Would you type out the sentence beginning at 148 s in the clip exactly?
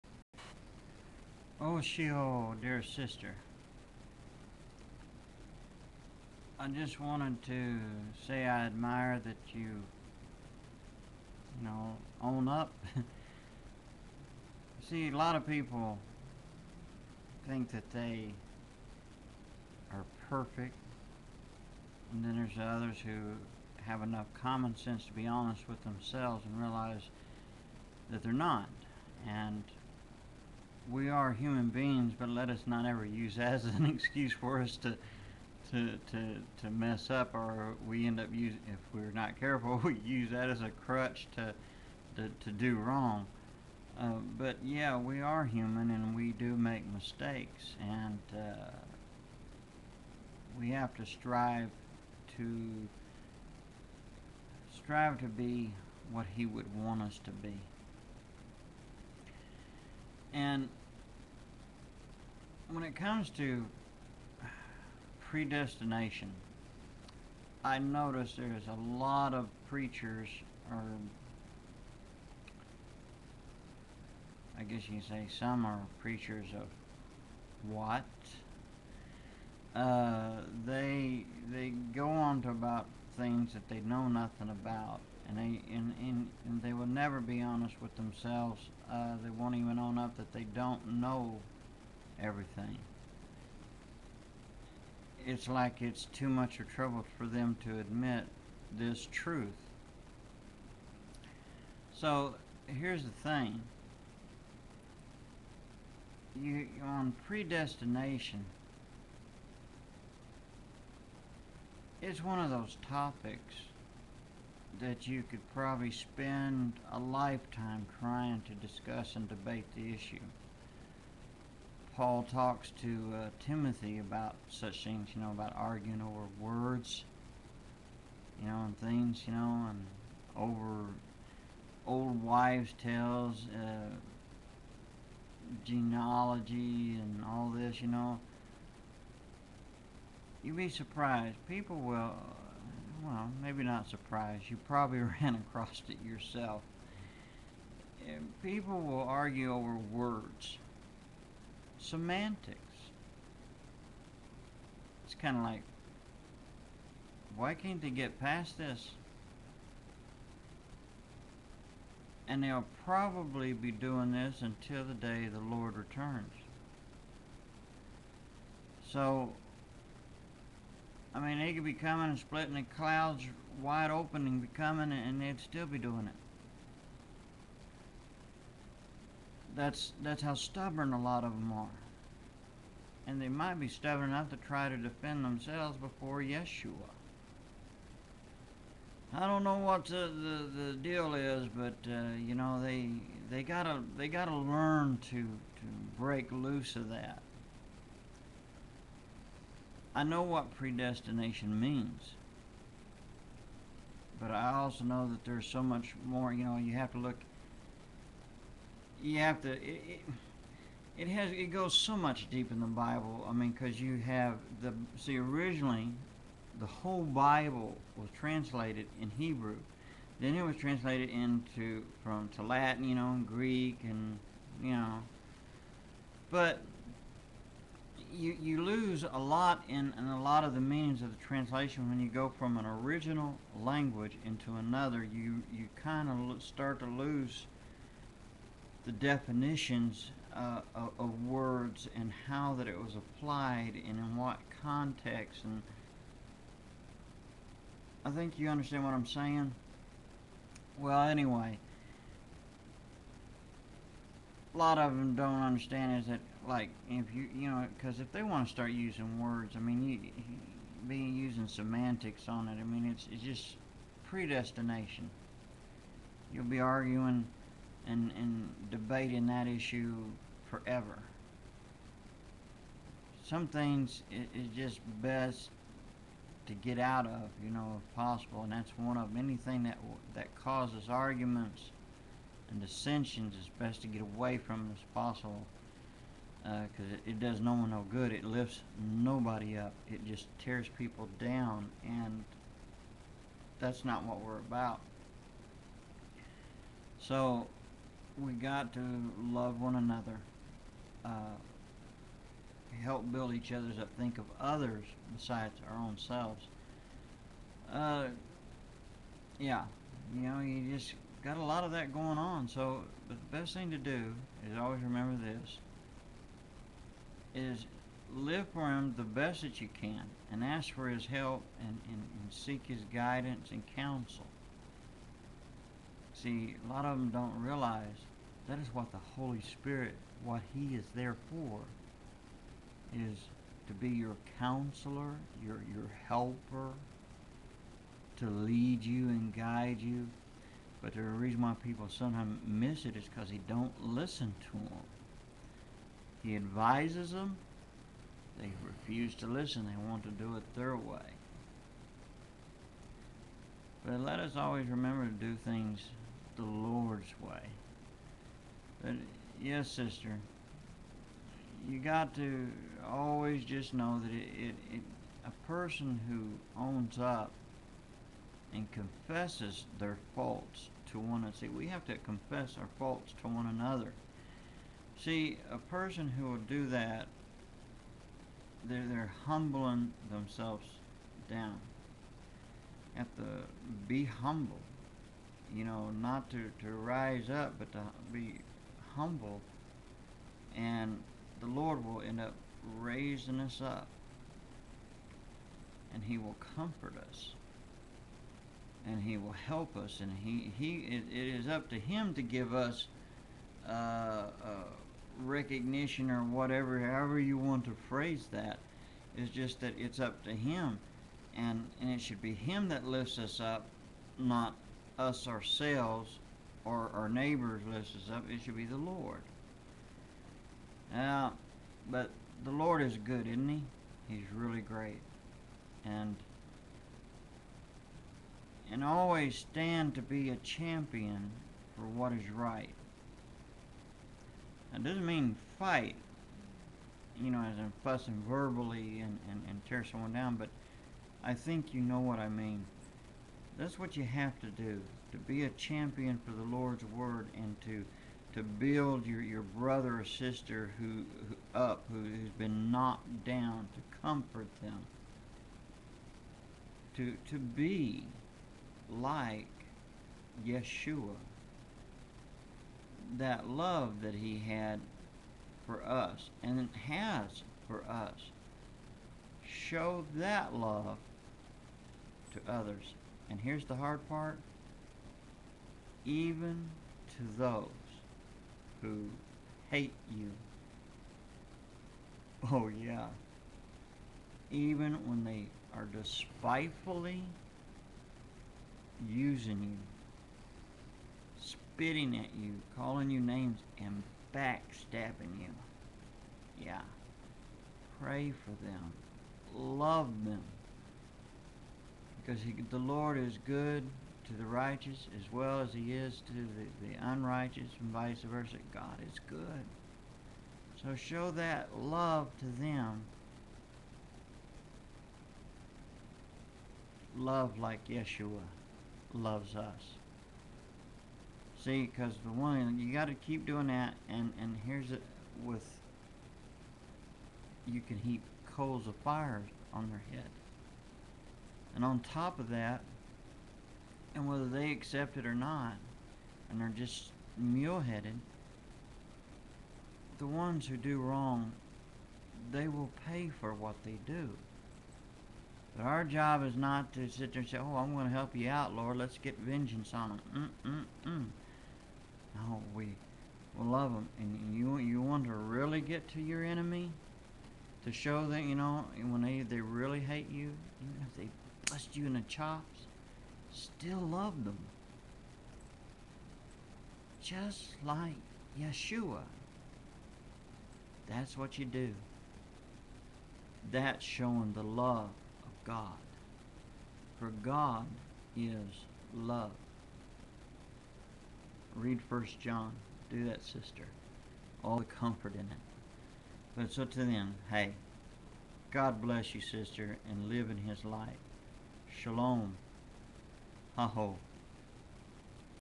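and People will argue over words semantics.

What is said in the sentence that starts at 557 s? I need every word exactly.
To show that, you know, when they, they really hate you, even if they bust you in the chops, still loved them.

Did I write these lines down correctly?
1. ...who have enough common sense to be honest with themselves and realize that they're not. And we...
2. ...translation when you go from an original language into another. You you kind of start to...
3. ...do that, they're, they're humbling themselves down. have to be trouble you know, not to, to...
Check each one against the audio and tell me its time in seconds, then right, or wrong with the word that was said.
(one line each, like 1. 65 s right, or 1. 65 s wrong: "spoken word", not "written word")
1. 23 s right
2. 231 s right
3. 376 s wrong: "humble", not "trouble".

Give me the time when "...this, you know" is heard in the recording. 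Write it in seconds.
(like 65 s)
137 s.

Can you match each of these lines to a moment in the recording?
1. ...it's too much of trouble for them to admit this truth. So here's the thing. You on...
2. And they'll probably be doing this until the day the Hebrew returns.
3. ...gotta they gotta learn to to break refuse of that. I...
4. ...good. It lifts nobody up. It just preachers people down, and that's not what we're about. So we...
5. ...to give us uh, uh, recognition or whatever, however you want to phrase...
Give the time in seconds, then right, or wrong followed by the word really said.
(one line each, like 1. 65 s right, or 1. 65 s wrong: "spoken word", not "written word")
1. 95 s right
2. 162 s wrong: "Lord", not "Hebrew"
3. 193 s wrong: "loose", not "refuse"
4. 287 s wrong: "tears", not "preachers"
5. 402 s right.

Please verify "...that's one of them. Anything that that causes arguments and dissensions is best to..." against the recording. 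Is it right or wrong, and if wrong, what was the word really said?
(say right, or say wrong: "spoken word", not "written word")
right.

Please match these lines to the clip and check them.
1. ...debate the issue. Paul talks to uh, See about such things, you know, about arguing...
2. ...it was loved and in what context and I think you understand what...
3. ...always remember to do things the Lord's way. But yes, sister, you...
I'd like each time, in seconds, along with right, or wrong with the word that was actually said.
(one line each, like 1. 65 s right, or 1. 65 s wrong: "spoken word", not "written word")
1. 119 s wrong: "Timothy", not "See"
2. 242 s wrong: "applied", not "loved"
3. 354 s right.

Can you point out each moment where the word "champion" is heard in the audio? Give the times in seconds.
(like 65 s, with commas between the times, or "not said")
430 s, 445 s.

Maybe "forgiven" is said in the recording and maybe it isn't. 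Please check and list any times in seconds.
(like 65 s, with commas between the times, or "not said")
not said.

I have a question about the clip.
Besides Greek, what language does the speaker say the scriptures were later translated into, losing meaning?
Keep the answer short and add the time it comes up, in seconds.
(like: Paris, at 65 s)
Latin, at 222 s.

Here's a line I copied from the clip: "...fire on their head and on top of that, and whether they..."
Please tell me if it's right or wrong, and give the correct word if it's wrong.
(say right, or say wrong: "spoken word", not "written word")
right.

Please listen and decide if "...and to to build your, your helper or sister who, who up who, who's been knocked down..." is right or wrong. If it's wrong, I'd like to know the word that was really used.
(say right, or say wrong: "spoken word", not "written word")
wrong: "brother", not "helper".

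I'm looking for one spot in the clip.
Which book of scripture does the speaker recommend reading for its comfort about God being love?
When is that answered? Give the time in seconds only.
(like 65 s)
582 s.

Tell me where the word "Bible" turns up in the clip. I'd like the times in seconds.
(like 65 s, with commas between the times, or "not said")
212 s, 217 s.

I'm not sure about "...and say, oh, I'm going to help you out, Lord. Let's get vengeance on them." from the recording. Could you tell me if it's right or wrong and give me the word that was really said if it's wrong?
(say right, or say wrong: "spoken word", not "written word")
right.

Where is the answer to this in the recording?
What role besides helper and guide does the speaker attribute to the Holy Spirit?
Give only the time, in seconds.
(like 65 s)
334 s.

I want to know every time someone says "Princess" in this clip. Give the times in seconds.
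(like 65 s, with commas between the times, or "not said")
not said.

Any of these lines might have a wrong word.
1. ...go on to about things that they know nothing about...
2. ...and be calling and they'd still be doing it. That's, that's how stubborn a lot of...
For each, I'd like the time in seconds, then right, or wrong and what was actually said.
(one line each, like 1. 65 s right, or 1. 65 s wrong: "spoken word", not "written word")
1. 81 s right
2. 174 s wrong: "coming", not "calling".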